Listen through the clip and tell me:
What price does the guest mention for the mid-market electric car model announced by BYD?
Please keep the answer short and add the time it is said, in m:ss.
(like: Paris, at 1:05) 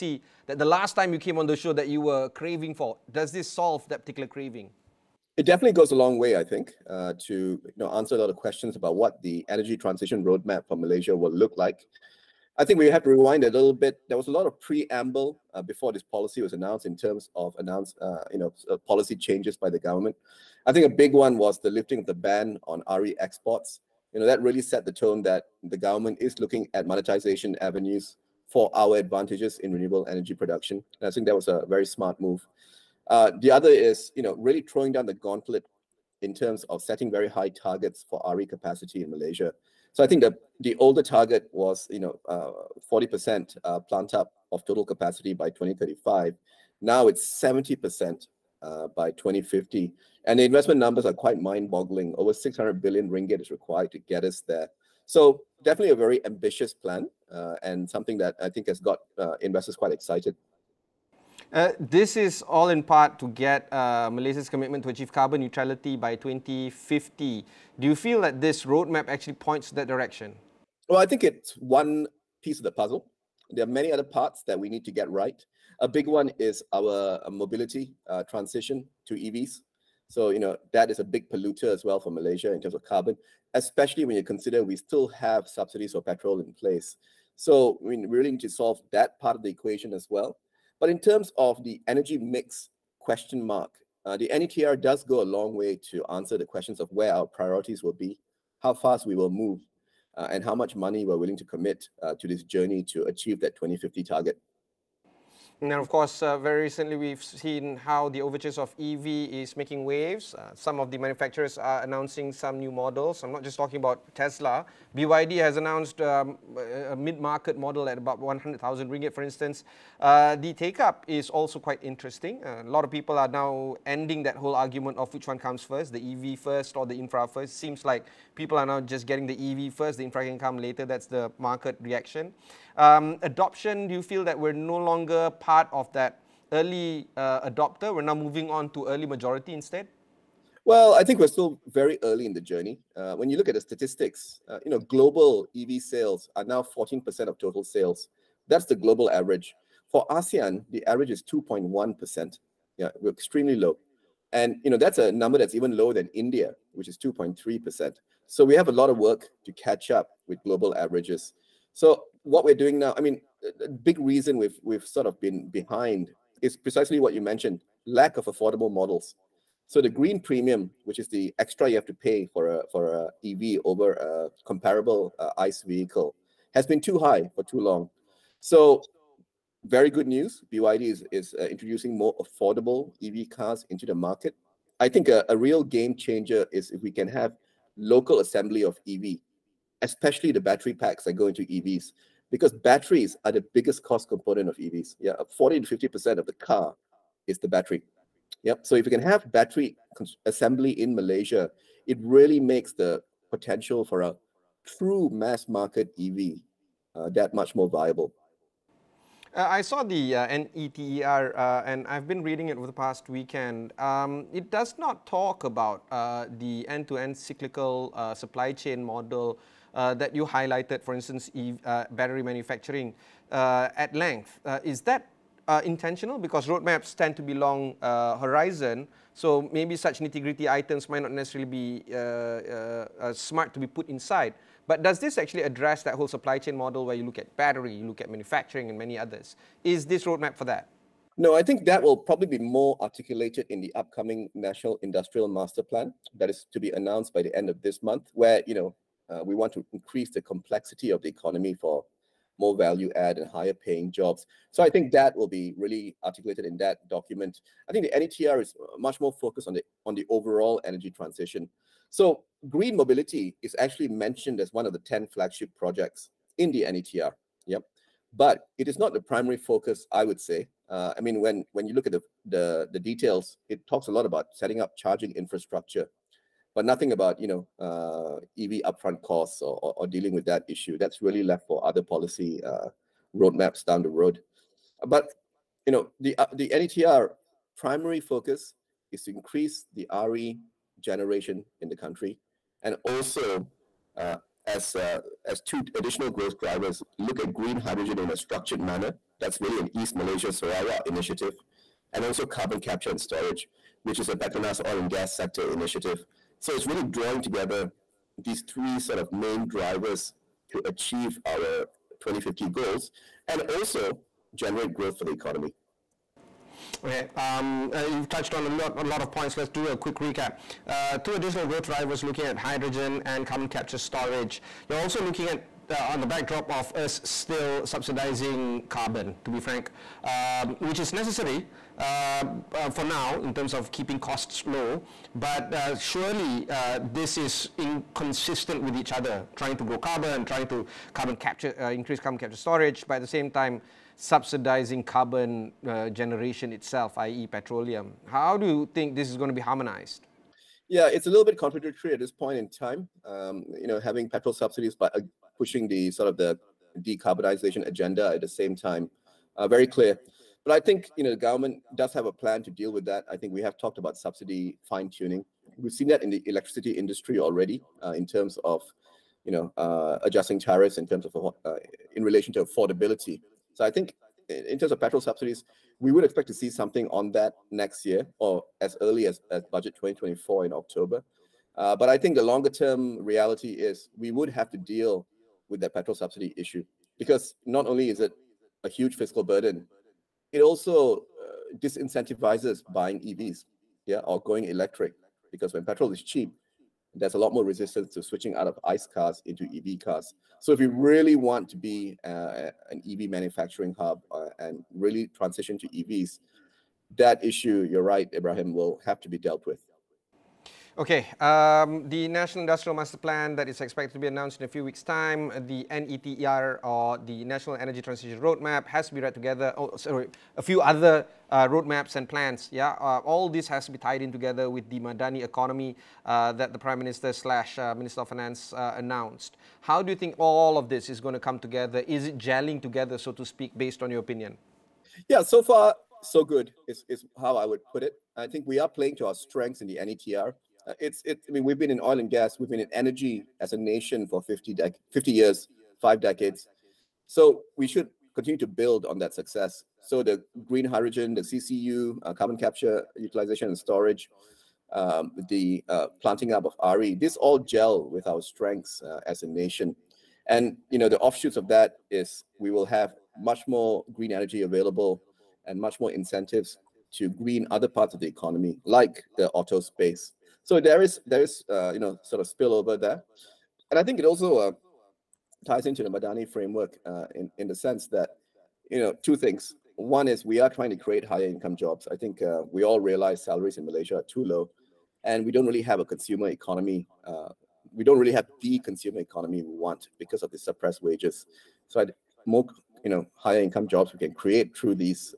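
100,000 ringgit, at 1:58.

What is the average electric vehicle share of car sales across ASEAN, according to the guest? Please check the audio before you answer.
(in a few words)
2.1%.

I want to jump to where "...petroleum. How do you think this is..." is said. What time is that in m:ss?
5:47.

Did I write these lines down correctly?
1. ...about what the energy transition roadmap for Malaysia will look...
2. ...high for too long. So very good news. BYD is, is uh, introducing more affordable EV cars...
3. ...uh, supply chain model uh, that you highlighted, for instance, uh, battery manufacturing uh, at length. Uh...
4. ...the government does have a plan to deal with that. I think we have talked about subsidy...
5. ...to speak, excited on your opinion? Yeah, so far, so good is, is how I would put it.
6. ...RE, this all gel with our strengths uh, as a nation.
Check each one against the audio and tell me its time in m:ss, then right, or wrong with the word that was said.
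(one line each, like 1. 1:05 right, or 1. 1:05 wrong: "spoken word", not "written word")
1. 0:08 right
2. 2:56 right
3. 3:37 right
4. 6:01 right
5. 7:13 wrong: "based", not "excited"
6. 7:36 right.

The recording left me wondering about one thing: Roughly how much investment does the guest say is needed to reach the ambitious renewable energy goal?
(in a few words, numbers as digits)
Over 600 billion ringgit.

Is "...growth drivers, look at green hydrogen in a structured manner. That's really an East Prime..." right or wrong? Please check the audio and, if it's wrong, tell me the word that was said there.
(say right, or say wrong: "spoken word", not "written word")
wrong: "Malaysia", not "Prime".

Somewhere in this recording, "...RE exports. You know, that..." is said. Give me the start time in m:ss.
0:22.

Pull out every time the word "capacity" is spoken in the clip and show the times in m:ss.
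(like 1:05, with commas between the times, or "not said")
0:38, 0:44.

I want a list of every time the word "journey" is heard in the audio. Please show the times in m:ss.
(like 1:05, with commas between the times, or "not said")
1:42, 2:22.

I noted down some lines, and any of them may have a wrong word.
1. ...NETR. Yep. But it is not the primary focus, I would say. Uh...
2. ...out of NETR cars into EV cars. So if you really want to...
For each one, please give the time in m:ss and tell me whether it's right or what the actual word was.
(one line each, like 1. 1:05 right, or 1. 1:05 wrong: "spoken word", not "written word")
1. 4:26 right
2. 6:38 wrong: "ICE", not "NETR".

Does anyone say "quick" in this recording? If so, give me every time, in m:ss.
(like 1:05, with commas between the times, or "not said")
5:19.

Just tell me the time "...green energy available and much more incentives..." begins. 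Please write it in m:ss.
7:43.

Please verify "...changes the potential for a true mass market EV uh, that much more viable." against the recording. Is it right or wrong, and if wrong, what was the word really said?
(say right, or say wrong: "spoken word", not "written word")
wrong: "makes", not "changes".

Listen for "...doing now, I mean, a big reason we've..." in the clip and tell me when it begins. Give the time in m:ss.
2:42.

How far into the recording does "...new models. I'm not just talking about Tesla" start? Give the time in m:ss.
1:52.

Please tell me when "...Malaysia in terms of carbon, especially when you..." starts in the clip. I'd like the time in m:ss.
1:22.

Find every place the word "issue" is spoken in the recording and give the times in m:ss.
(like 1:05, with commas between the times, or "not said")
4:40, 6:26, 6:47.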